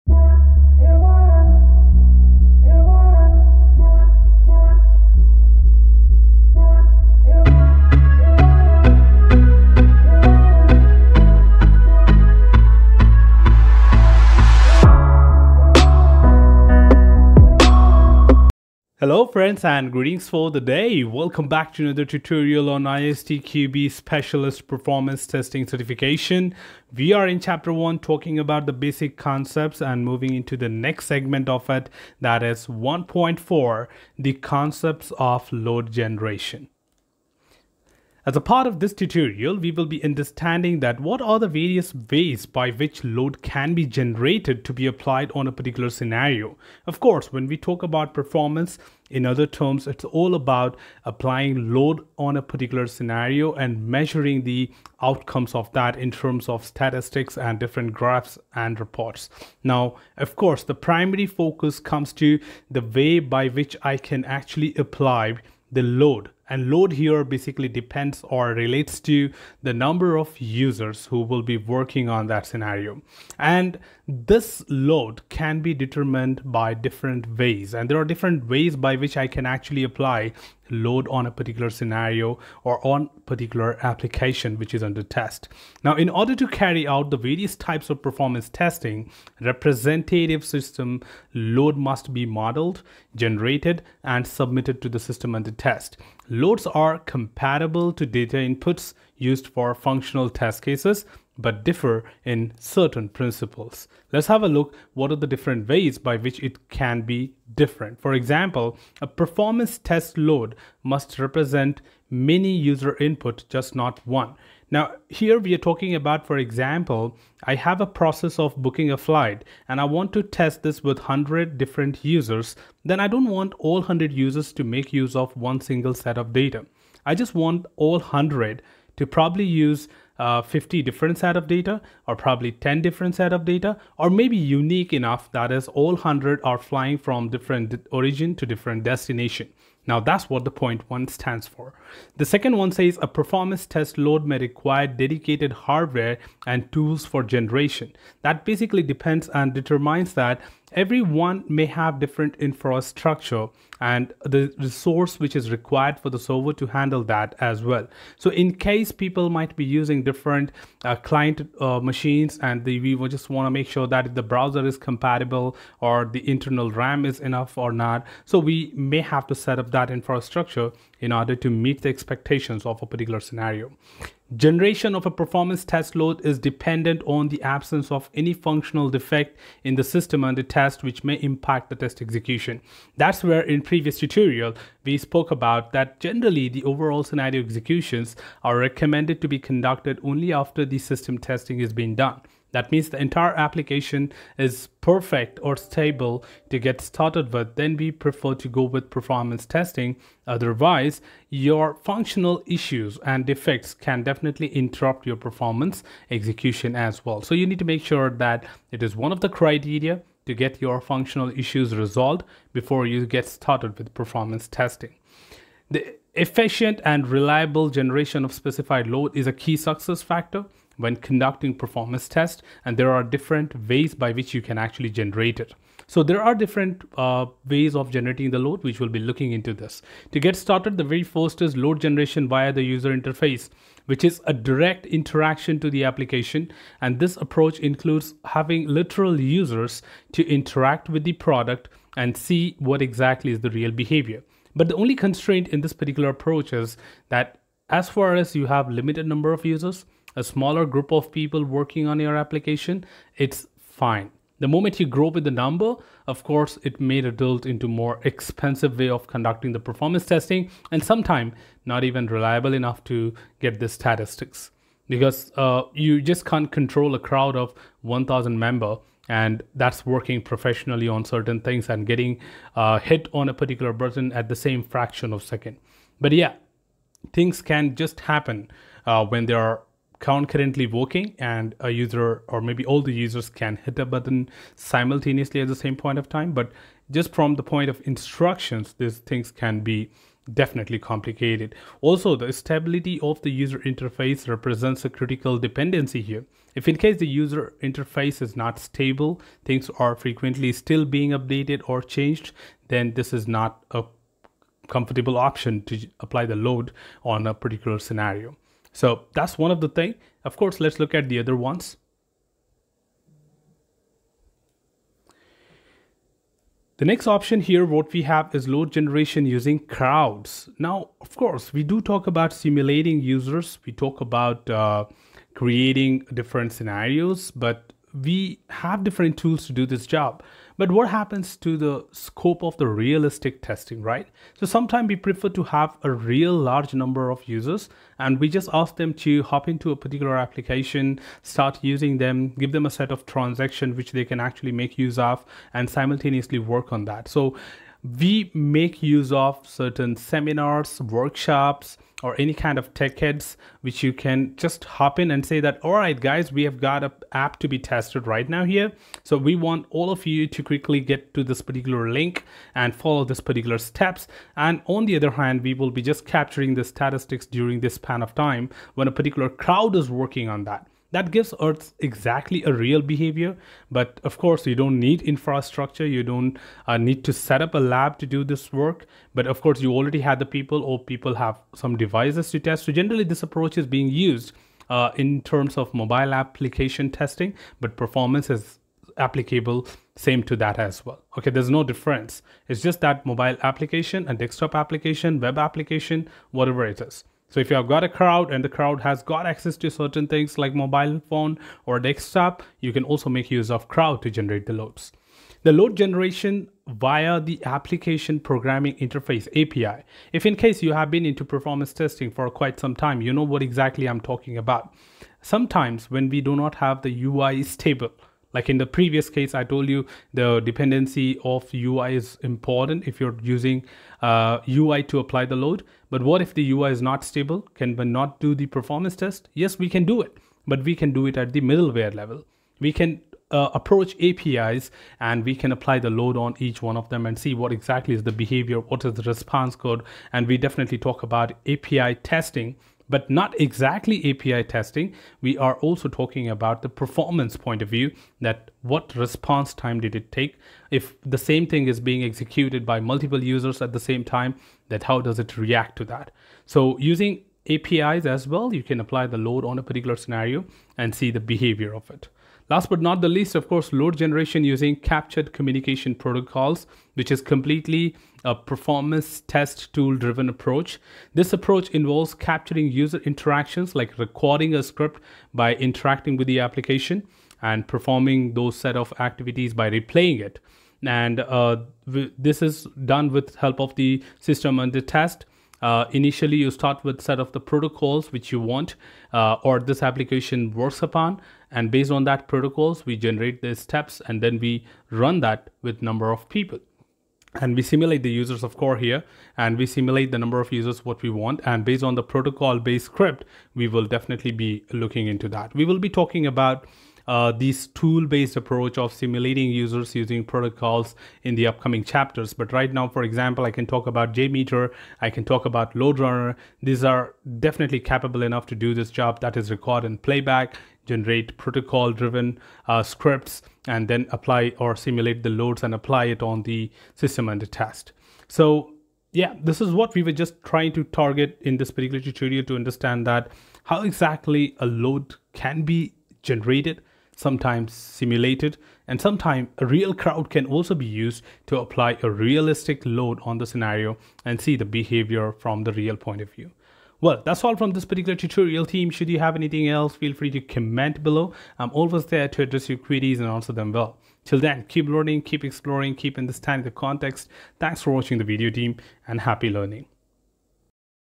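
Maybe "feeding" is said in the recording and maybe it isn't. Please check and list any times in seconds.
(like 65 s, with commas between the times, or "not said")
not said.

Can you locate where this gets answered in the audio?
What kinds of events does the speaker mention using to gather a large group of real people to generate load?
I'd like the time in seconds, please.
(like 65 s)
349 s.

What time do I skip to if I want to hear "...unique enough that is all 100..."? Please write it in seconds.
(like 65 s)
134 s.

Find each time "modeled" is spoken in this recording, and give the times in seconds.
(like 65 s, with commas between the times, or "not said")
92 s.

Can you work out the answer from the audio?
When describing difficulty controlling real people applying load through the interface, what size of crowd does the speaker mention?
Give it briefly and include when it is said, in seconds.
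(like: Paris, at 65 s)
1,000, at 267 s.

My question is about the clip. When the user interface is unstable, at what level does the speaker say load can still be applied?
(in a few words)
Middleware level.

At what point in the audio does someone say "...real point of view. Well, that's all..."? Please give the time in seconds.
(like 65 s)
545 s.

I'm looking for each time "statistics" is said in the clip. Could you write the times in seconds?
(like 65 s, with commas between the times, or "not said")
56 s, 263 s, 366 s.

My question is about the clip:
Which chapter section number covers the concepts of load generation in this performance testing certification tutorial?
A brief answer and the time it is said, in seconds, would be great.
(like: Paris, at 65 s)
1.4, at 32 s.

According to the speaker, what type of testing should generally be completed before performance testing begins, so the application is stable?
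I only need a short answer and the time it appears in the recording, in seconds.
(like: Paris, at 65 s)
System testing, at 190 s.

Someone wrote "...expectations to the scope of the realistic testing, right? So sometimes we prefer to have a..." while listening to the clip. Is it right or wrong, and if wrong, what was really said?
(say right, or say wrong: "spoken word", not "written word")
wrong: "happens", not "expectations".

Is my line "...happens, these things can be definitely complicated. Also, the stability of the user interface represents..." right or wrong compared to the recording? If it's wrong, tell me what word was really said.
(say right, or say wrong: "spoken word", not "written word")
wrong: "instructions", not "happens".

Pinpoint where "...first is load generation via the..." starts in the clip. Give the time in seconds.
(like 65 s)
231 s.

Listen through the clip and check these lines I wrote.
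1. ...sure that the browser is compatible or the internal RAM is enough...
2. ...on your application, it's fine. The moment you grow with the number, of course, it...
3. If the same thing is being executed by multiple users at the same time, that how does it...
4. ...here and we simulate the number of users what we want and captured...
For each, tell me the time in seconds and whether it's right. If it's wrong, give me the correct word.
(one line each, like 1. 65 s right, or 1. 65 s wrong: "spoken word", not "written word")
1. 163 s right
2. 251 s right
3. 450 s right
4. 498 s wrong: "based", not "captured".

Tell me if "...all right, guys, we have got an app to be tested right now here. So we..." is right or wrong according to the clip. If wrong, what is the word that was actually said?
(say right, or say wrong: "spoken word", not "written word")
right.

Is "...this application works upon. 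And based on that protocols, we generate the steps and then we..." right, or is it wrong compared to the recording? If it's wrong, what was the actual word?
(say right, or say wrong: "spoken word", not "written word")
right.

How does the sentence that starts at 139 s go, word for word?
Now that's what the point one stands for.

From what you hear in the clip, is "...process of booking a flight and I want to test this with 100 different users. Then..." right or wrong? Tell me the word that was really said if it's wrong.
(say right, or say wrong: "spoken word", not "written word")
right.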